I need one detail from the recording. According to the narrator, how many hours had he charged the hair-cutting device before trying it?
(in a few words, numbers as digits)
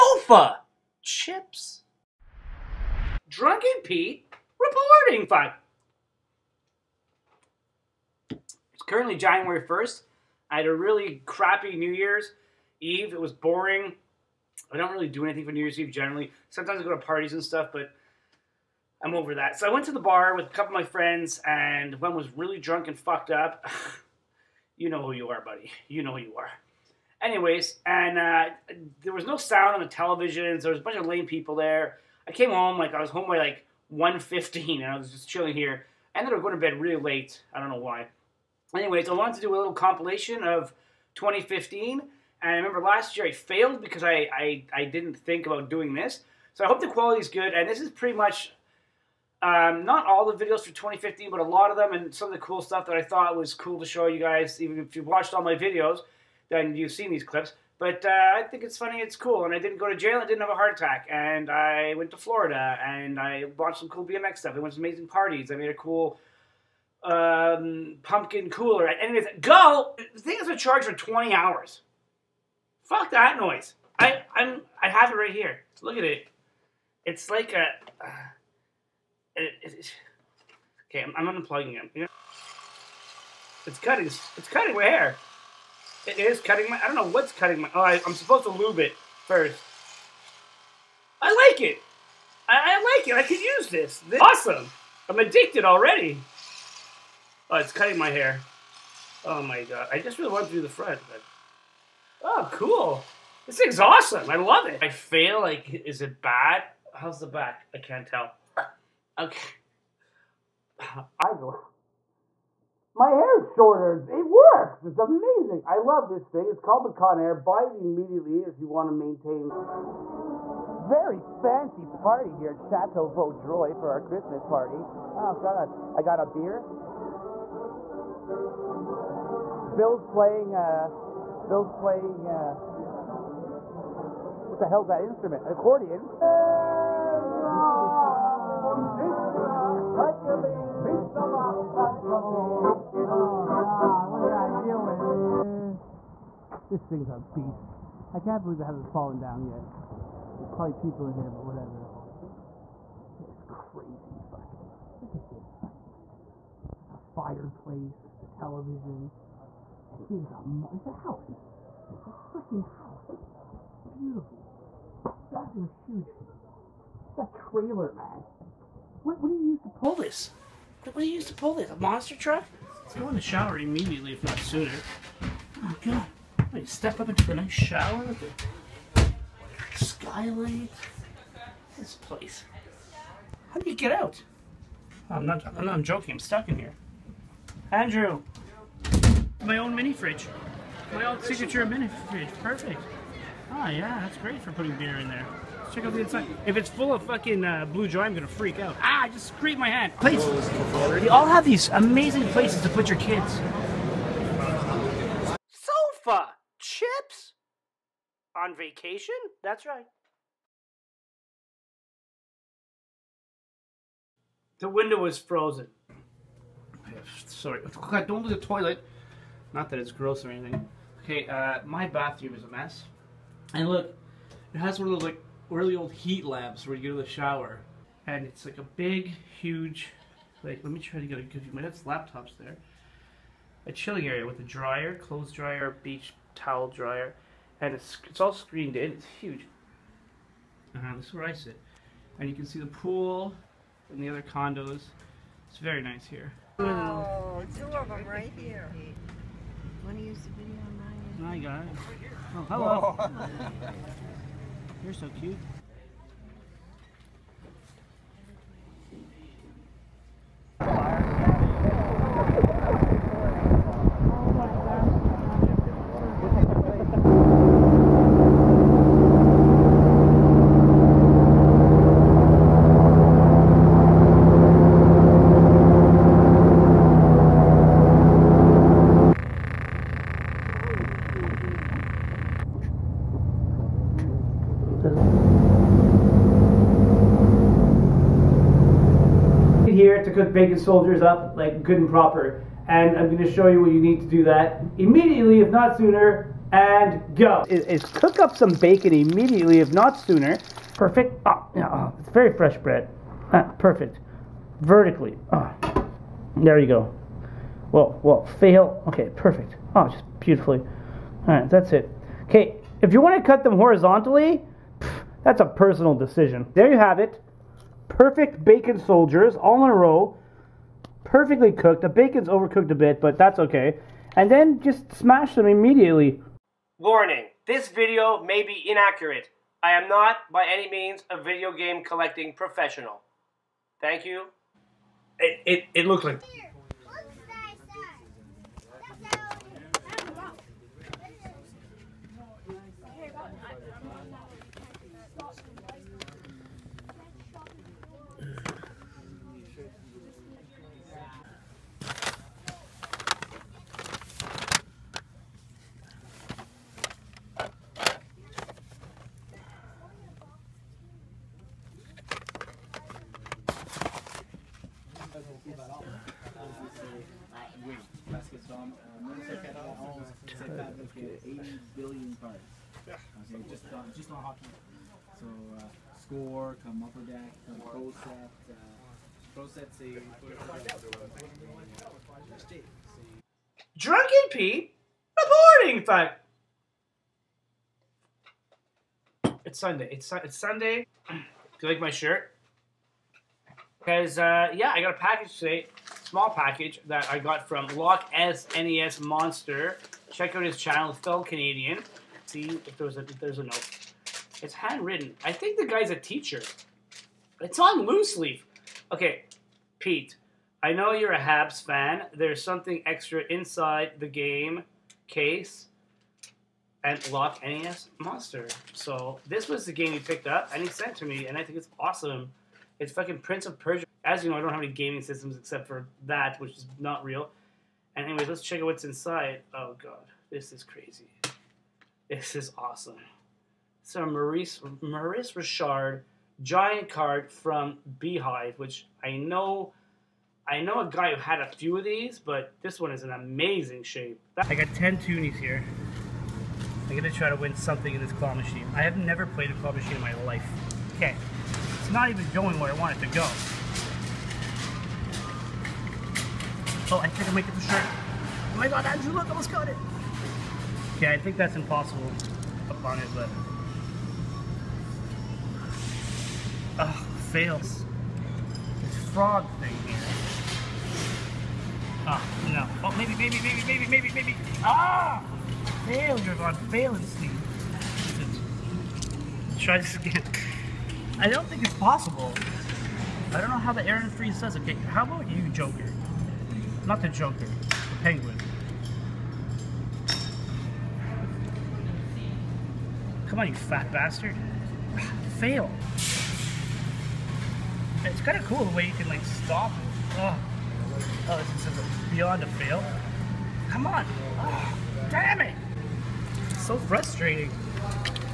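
20.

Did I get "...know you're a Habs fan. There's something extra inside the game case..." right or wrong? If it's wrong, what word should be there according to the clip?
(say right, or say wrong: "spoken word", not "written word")
right.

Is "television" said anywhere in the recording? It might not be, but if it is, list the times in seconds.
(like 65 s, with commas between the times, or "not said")
29 s, 158 s.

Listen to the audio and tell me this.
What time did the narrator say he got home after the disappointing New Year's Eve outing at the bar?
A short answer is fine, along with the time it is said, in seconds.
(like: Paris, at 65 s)
1:15, at 33 s.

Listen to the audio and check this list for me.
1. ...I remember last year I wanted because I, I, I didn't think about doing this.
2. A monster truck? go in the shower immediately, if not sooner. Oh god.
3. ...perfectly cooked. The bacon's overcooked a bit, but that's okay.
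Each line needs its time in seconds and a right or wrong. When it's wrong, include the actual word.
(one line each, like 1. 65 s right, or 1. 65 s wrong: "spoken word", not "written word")
1. 42 s wrong: "failed", not "wanted"
2. 171 s right
3. 321 s right.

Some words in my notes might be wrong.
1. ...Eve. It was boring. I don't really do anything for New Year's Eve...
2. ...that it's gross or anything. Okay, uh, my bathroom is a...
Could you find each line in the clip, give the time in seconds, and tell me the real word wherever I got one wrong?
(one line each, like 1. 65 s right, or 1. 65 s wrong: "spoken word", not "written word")
1. 12 s right
2. 219 s right.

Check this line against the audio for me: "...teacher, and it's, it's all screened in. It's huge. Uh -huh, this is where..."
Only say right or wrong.
wrong.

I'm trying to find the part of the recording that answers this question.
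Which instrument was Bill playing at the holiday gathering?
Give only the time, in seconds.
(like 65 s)
135 s.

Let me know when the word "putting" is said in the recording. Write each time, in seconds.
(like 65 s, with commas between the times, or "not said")
194 s.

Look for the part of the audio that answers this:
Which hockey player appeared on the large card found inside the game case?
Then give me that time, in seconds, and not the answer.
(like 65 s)
434 s.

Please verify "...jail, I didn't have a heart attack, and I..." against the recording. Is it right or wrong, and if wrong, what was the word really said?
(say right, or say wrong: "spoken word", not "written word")
right.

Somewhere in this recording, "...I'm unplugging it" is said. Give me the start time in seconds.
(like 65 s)
81 s.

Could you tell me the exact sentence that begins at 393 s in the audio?
Because, uh, yeah, I got a package today, small package that I got from Lock S NES Monster.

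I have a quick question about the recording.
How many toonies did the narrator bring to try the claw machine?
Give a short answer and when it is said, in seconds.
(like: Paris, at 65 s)
10, at 444 s.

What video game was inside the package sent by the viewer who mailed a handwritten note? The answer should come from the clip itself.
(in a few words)
Prince of Persia.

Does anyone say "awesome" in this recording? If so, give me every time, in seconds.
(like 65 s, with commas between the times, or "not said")
94 s, 103 s, 421 s, 432 s.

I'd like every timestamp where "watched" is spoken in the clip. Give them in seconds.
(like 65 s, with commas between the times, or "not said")
55 s, 63 s.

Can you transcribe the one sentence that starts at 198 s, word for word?
Ah, I just scraped my hand.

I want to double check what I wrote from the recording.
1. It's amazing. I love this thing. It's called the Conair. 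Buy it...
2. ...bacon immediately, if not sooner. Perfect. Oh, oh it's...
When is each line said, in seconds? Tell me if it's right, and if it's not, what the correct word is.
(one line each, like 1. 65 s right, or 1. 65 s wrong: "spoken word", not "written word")
1. 114 s right
2. 298 s right.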